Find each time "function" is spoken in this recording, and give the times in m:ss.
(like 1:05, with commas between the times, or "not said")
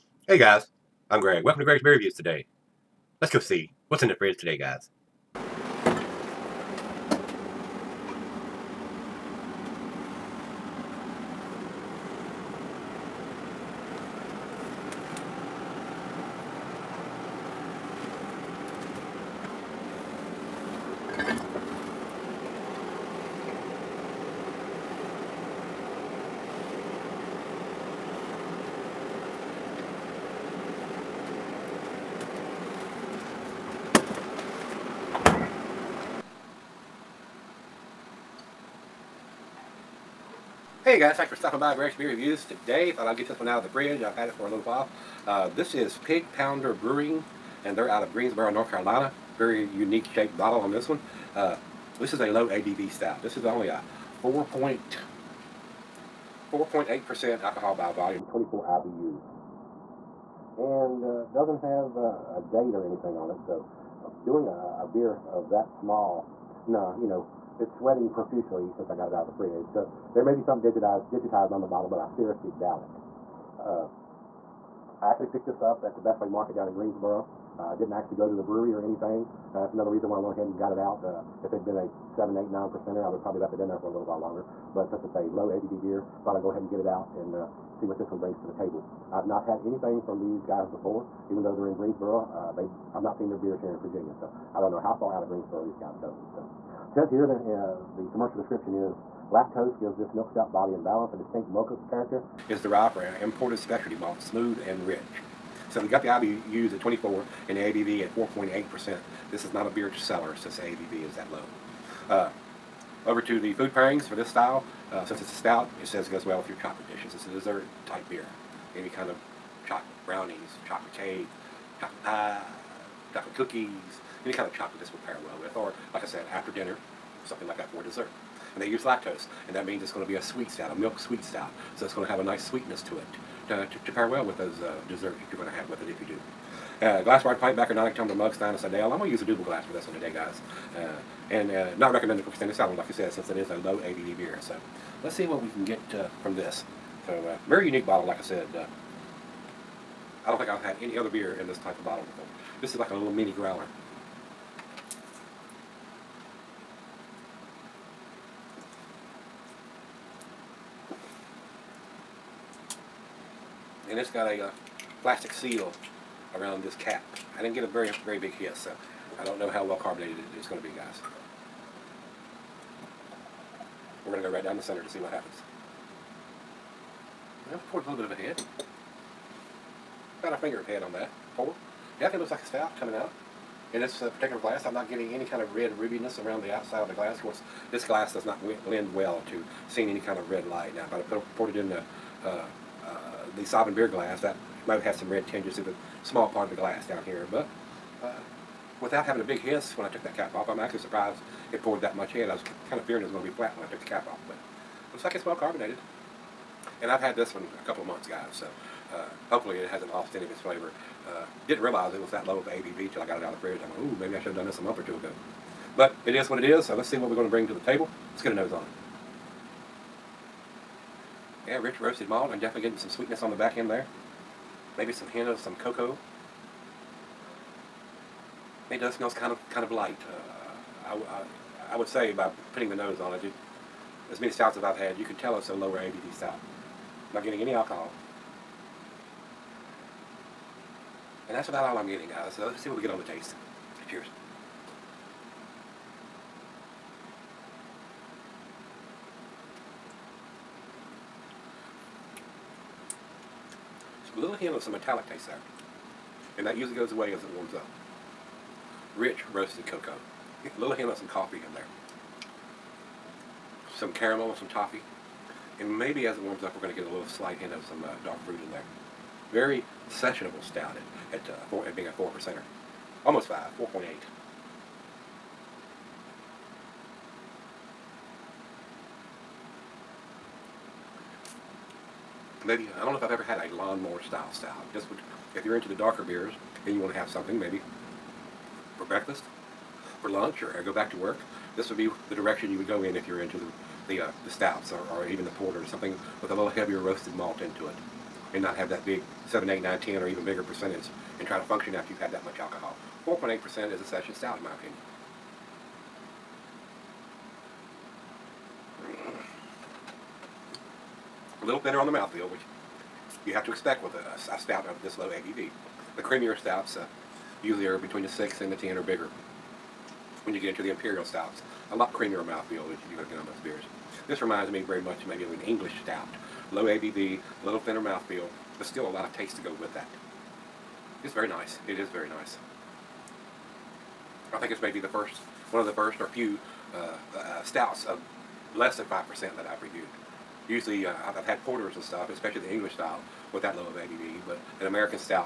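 5:01.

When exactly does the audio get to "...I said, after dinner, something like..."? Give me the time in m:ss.
2:06.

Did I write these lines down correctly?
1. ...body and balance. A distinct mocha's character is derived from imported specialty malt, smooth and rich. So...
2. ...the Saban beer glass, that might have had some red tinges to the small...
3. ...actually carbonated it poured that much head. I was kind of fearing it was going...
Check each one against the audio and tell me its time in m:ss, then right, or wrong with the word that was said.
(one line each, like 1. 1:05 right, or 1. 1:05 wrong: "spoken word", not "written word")
1. 1:40 right
2. 3:13 right
3. 3:20 wrong: "surprised", not "carbonated".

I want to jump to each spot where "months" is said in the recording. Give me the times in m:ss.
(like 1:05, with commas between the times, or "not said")
3:27, 3:34.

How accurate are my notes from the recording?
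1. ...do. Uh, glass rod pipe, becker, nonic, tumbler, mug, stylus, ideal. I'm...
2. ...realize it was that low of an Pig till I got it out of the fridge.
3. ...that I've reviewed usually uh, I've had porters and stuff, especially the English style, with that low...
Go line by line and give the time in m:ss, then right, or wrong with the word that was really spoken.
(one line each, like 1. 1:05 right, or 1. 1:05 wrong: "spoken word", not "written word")
1. 2:16 right
2. 3:31 wrong: "ABV", not "Pig"
3. 5:39 right.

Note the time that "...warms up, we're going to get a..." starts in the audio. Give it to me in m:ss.
4:26.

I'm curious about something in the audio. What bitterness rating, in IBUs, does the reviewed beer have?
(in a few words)
24.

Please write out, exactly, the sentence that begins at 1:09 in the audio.
So there may be some digitized, digitized on the bottle, but I seriously doubt it.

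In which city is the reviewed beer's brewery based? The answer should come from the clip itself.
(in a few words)
Greensboro, North Carolina.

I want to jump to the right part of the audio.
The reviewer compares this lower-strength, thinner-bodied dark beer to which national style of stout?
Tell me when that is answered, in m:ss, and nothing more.
5:25.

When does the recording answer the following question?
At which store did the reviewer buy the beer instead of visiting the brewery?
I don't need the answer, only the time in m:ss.
1:16.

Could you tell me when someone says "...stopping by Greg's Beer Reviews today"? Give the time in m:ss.
0:41.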